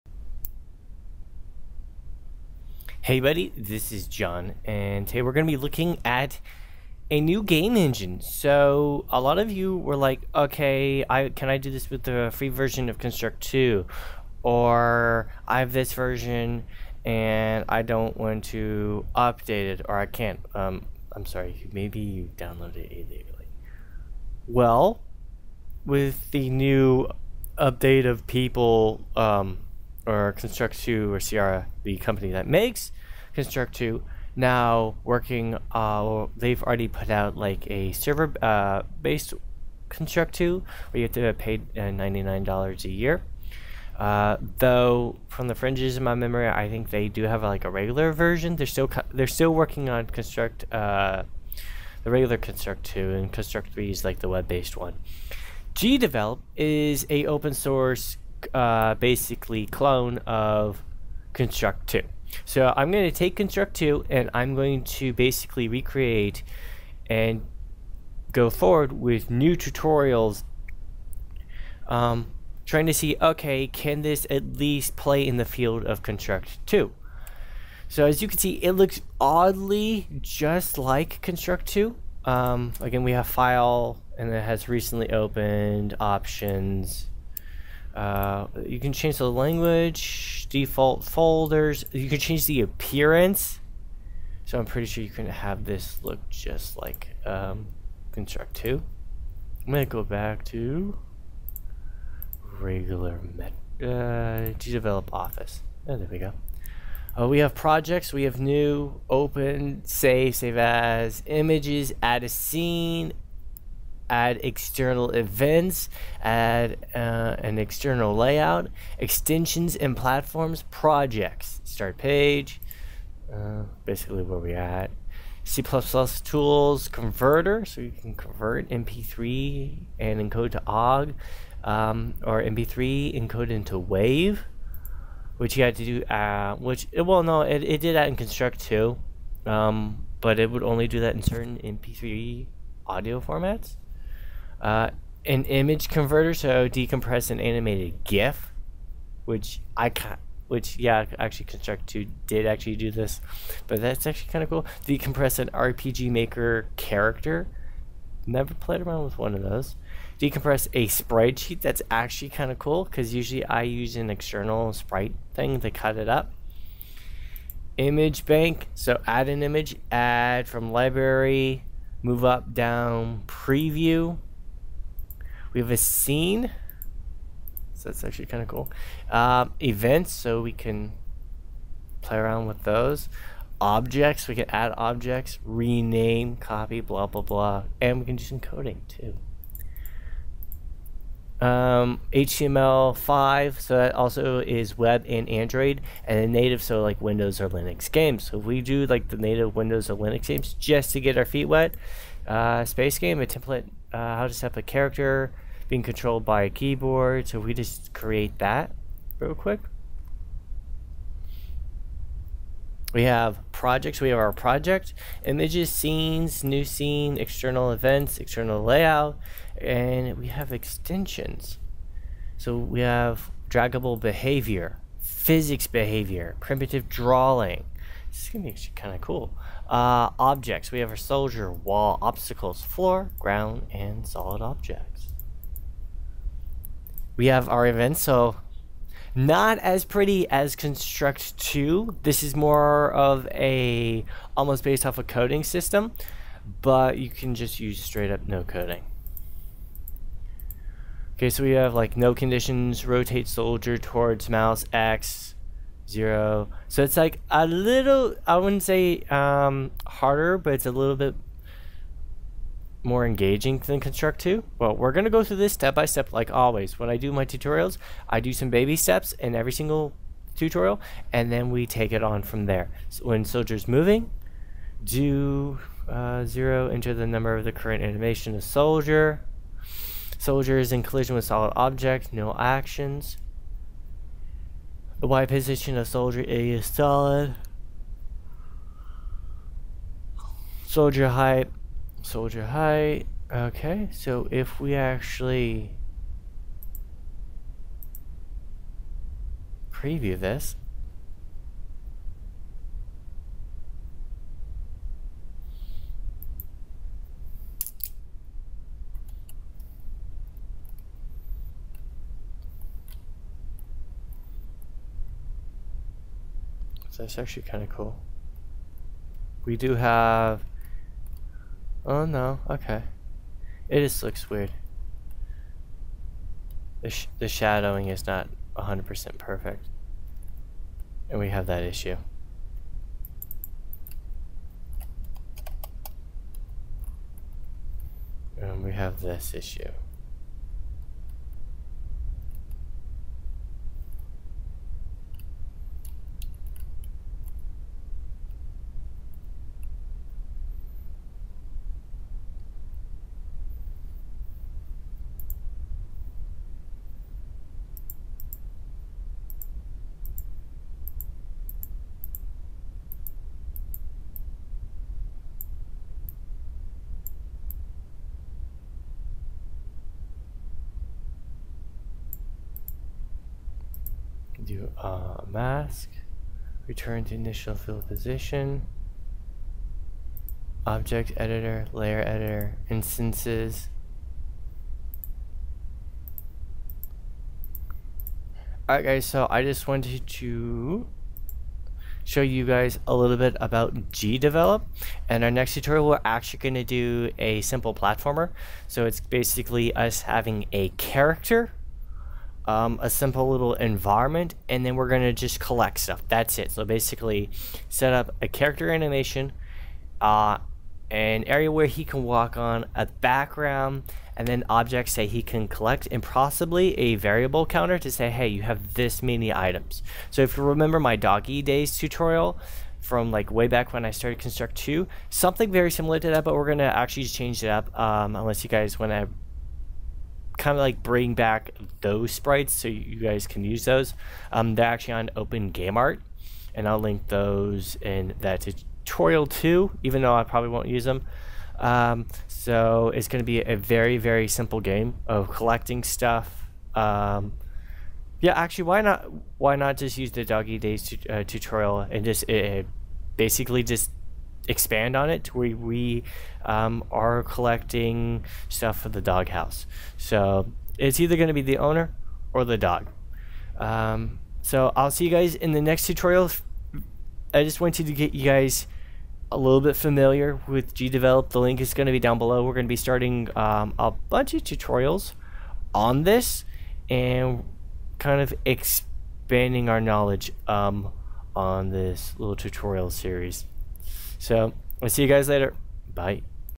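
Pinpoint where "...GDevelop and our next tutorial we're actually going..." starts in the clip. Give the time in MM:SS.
06:33.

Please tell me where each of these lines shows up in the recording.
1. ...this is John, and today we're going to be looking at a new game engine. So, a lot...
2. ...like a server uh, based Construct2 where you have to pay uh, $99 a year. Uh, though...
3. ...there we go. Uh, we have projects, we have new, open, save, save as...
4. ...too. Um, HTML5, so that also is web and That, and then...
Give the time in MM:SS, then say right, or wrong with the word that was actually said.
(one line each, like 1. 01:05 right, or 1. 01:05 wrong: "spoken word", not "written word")
1. 00:03 right
2. 00:37 right
3. 01:45 right
4. 03:08 wrong: "Android", not "That".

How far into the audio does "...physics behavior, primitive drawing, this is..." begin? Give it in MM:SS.
03:44.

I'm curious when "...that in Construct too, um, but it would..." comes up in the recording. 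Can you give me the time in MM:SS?
02:17.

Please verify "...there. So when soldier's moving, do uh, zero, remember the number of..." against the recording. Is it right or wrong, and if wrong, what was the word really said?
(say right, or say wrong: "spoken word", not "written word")
wrong: "enter", not "remember".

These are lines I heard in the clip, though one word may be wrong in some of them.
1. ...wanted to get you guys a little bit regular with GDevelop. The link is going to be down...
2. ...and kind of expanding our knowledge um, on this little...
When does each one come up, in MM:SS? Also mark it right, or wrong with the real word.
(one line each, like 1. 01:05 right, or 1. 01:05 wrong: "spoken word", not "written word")
1. 07:47 wrong: "familiar", not "regular"
2. 07:56 right.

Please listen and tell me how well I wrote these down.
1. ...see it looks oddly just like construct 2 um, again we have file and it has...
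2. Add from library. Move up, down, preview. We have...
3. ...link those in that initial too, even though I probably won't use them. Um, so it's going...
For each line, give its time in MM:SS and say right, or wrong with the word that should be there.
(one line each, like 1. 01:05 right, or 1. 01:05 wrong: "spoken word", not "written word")
1. 01:18 right
2. 02:49 right
3. 07:16 wrong: "tutorial", not "initial".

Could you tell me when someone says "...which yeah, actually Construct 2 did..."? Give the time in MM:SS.
02:30.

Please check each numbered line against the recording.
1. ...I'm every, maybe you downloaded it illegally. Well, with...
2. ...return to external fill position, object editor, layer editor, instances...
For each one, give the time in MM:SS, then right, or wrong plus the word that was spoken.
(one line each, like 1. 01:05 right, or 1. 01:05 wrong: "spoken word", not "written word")
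1. 00:21 wrong: "sorry", not "every"
2. 06:16 wrong: "initial", not "external".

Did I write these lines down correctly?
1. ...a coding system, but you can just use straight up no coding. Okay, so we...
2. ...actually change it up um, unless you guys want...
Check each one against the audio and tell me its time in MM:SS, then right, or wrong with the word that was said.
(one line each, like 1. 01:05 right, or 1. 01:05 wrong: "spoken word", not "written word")
1. 04:04 right
2. 07:06 right.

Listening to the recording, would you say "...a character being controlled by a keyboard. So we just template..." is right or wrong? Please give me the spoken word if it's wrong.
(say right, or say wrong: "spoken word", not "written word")
wrong: "create", not "template".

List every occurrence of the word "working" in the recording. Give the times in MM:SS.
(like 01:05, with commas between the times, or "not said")
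00:35, 00:49.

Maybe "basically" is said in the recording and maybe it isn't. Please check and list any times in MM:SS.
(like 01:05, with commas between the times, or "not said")
00:58, 01:05, 02:03, 06:39, 06:46, 07:33.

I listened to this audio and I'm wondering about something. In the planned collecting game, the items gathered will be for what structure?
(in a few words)
the doghouse.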